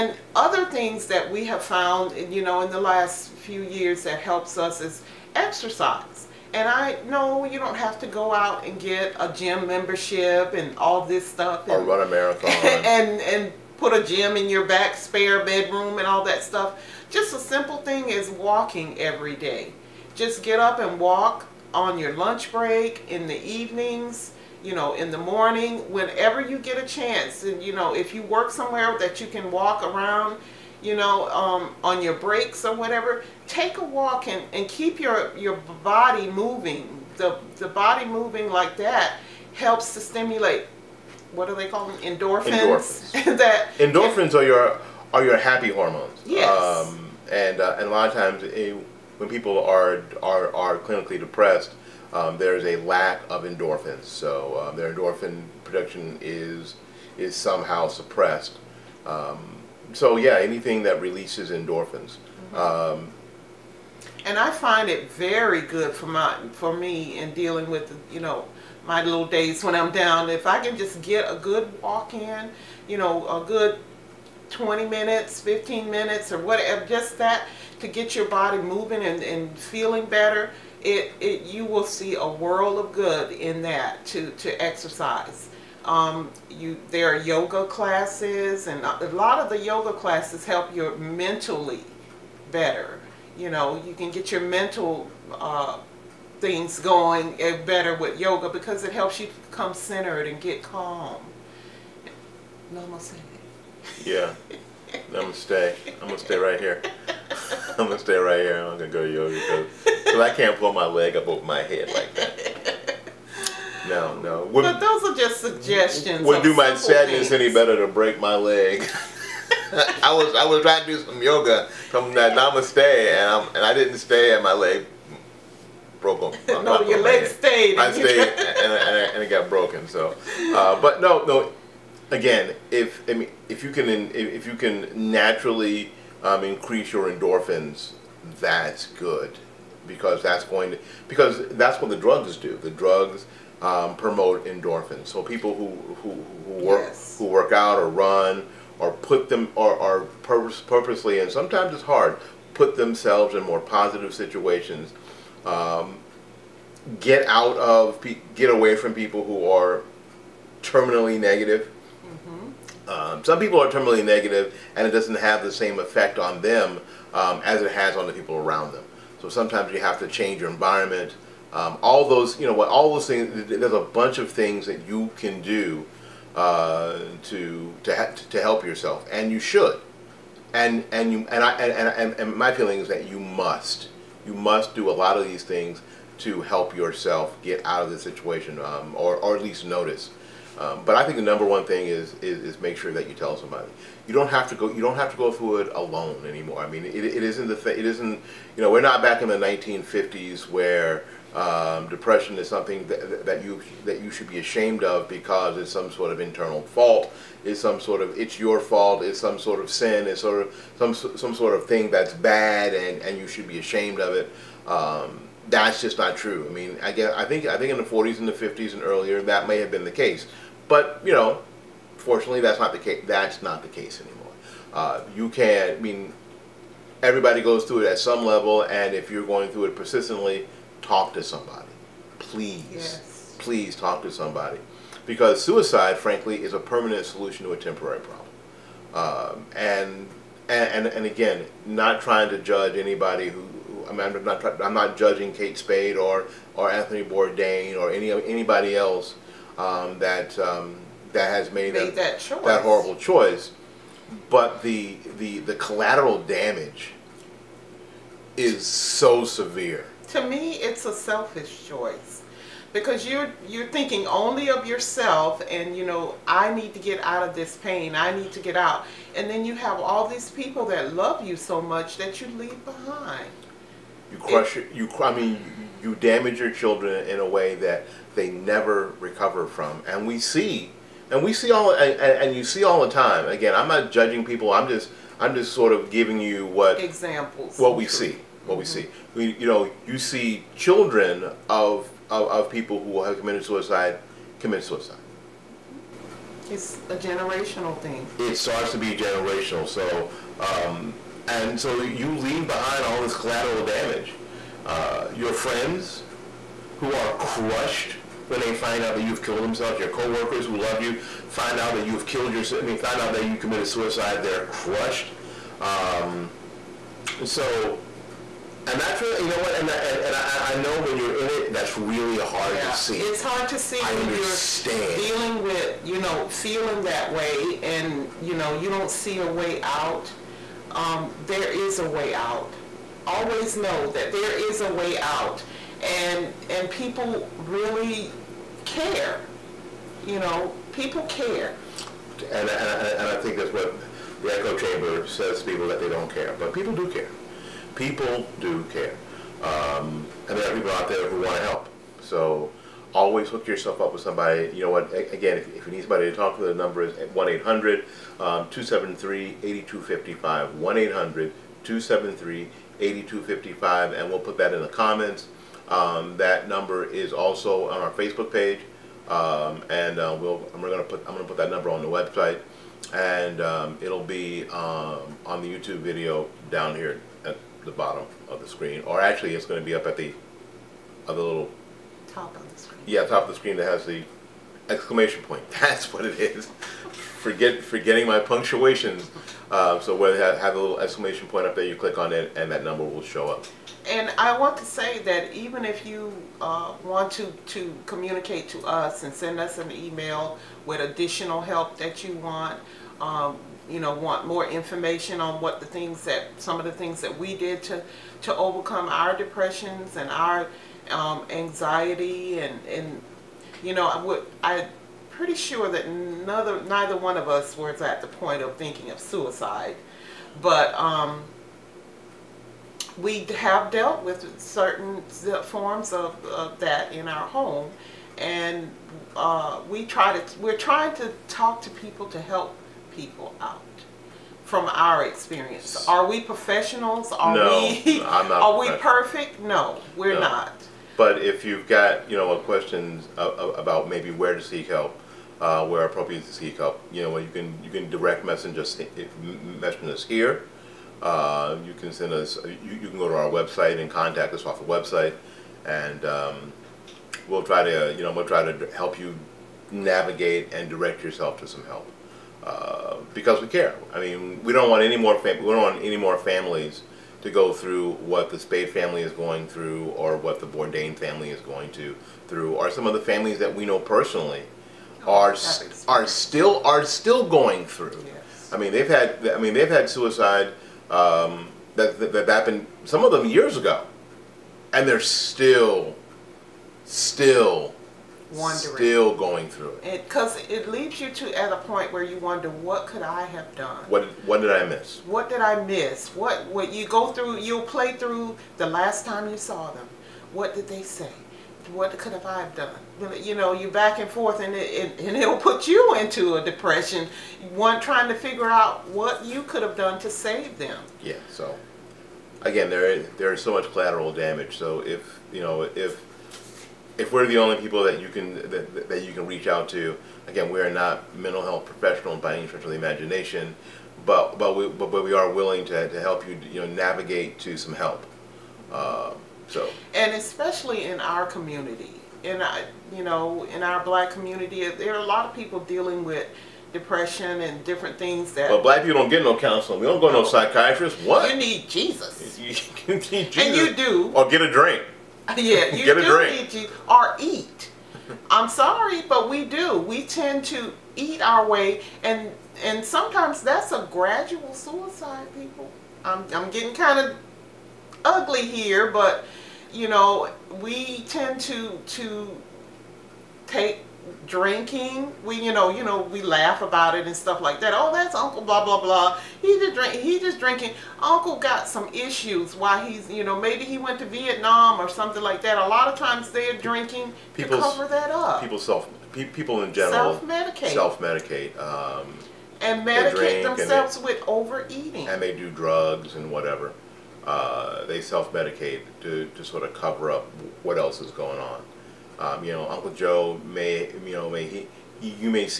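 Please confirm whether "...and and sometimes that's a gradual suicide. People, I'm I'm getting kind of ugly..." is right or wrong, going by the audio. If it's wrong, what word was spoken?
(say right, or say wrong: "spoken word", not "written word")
right.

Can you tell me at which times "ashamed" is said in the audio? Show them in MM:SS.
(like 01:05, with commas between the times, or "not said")
03:24, 03:33.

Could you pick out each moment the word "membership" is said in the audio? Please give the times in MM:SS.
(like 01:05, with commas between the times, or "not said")
00:09.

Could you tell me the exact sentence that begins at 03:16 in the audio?
I mean, it, it isn't the thing.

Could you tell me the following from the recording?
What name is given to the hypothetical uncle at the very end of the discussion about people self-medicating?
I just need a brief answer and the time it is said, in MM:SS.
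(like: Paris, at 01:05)
Uncle Joe, at 09:52.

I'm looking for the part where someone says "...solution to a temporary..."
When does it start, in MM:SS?
03:57.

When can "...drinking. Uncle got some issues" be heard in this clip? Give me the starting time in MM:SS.
09:30.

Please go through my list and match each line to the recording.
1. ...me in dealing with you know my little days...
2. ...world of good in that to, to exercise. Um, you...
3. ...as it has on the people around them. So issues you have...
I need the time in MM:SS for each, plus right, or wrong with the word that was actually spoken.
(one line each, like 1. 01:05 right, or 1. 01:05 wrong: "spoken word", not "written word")
1. 01:06 right
2. 01:22 right
3. 02:47 wrong: "sometimes", not "issues".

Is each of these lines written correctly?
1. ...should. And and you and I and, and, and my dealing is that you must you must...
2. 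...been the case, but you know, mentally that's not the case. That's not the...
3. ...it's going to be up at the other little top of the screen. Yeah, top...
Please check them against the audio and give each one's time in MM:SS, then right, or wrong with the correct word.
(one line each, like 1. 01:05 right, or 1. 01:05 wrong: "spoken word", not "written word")
1. 02:59 wrong: "feeling", not "dealing"
2. 03:39 wrong: "fortunately", not "mentally"
3. 06:19 right.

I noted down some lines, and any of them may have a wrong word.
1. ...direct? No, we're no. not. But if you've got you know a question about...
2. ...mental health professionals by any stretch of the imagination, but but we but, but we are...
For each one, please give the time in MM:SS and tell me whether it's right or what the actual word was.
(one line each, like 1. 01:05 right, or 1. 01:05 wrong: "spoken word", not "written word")
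1. 07:18 wrong: "perfect", not "direct"
2. 08:41 right.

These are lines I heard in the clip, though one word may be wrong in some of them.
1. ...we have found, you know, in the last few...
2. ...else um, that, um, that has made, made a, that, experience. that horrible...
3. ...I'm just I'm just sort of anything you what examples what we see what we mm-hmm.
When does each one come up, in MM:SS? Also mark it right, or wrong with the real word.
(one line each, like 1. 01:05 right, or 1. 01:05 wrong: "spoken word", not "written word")
1. 00:01 right
2. 04:08 wrong: "choice", not "experience"
3. 04:44 wrong: "giving", not "anything".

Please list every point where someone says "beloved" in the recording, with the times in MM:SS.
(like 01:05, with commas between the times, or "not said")
not said.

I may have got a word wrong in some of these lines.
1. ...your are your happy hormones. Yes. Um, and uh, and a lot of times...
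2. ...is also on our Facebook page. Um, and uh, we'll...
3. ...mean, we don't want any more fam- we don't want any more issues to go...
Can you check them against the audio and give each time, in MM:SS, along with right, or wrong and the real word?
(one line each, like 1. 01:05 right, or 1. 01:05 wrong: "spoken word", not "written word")
1. 00:44 right
2. 06:06 right
3. 07:44 wrong: "families", not "issues".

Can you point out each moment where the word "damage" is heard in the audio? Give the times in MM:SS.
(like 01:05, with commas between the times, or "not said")
04:16, 04:35, 05:03, 08:34.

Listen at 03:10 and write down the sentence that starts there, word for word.
Um, but I think the number one thing is, is, is make sure that you tell somebody.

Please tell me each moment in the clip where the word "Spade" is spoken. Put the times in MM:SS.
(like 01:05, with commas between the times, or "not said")
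04:05, 07:48.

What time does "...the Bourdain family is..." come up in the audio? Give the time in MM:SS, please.
07:50.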